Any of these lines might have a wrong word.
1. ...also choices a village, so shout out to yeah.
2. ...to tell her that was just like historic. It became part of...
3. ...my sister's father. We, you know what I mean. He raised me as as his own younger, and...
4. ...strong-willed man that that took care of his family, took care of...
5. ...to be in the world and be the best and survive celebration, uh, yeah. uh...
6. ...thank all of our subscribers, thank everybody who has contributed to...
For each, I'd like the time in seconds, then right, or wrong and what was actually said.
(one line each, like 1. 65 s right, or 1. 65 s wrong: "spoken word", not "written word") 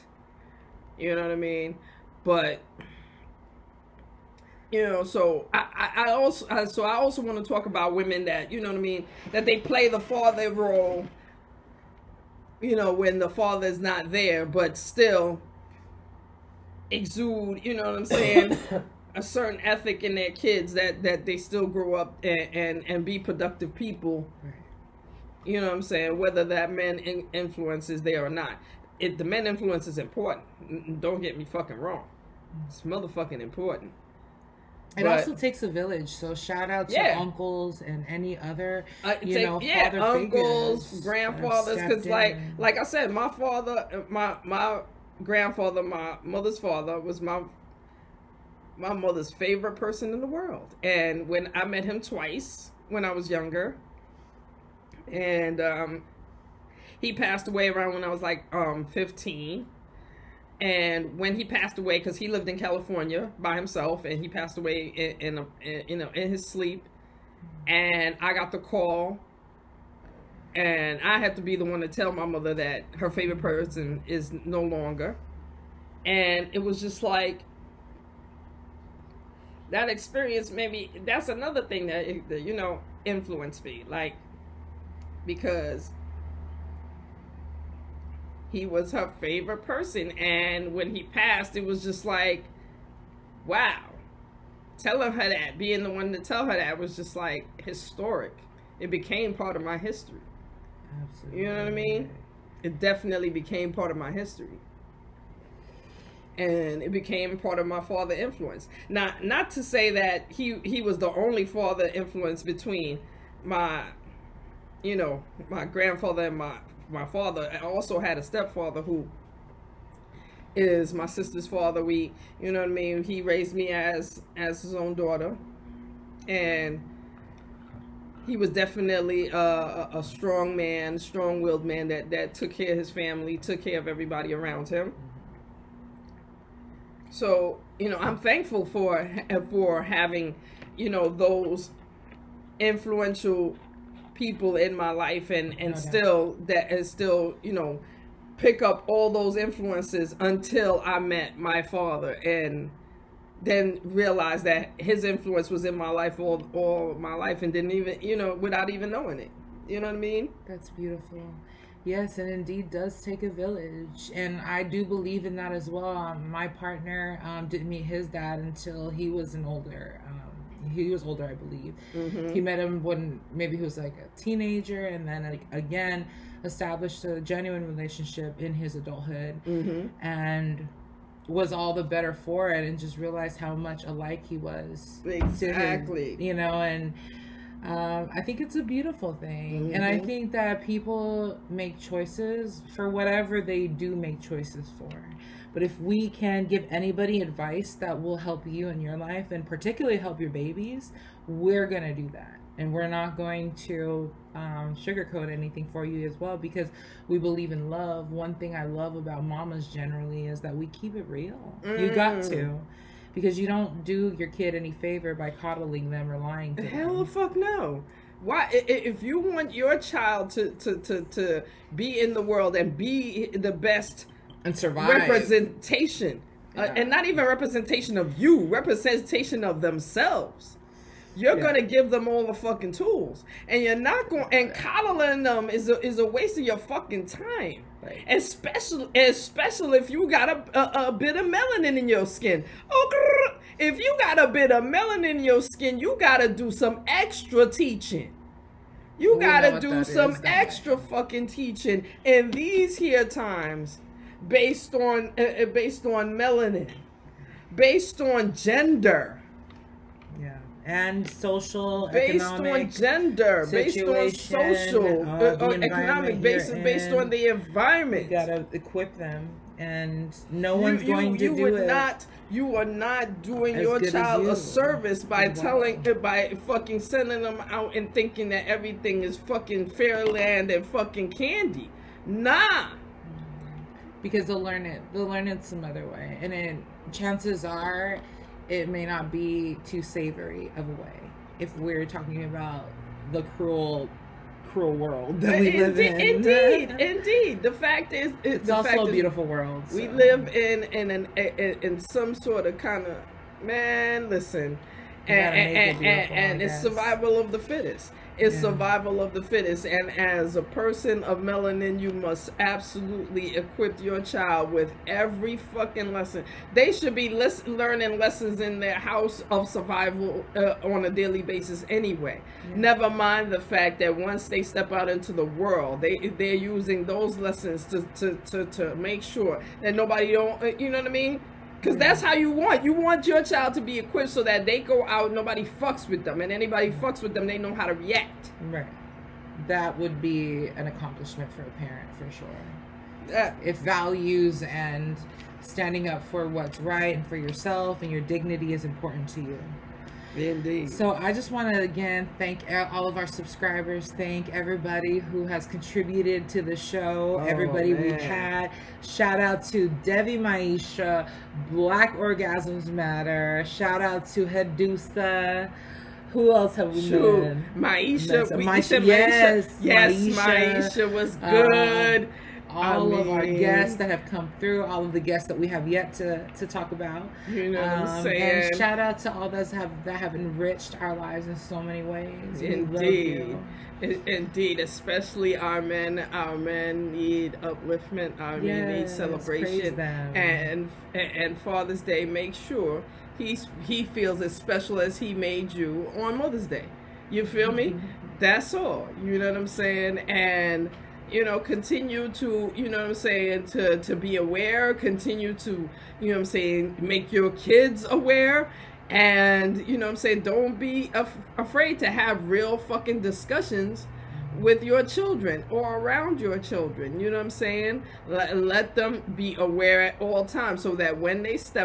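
1. 35 s wrong: "takes", not "choices"
2. 96 s right
3. 120 s wrong: "daughter", not "younger"
4. 130 s right
5. 221 s wrong: "representation", not "celebration"
6. 352 s right.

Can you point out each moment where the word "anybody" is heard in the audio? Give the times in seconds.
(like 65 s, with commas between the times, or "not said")
196 s, 336 s.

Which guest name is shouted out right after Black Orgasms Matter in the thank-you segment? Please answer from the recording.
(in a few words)
Hedusa.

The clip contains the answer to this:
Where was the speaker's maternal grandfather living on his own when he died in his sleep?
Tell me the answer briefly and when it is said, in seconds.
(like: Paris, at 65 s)
California, at 62 s.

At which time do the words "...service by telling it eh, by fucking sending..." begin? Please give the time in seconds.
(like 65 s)
274 s.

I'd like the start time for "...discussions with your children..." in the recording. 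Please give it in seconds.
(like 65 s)
413 s.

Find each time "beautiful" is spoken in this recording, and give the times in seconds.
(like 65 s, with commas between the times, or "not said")
160 s, 188 s, 298 s.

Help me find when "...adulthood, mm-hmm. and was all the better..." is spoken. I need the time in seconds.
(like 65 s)
178 s.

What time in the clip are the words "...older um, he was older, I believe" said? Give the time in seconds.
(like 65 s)
169 s.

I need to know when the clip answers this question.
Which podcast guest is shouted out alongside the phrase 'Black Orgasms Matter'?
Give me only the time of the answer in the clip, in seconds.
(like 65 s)
359 s.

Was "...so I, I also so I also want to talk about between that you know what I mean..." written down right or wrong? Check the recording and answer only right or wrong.
wrong.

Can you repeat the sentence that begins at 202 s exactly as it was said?
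And we're not going to um, sugarcoat anything for you as well because we believe in love.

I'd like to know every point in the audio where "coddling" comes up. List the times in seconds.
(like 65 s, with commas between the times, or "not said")
215 s, 234 s.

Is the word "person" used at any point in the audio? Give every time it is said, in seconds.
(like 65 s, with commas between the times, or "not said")
49 s, 73 s, 89 s, 310 s.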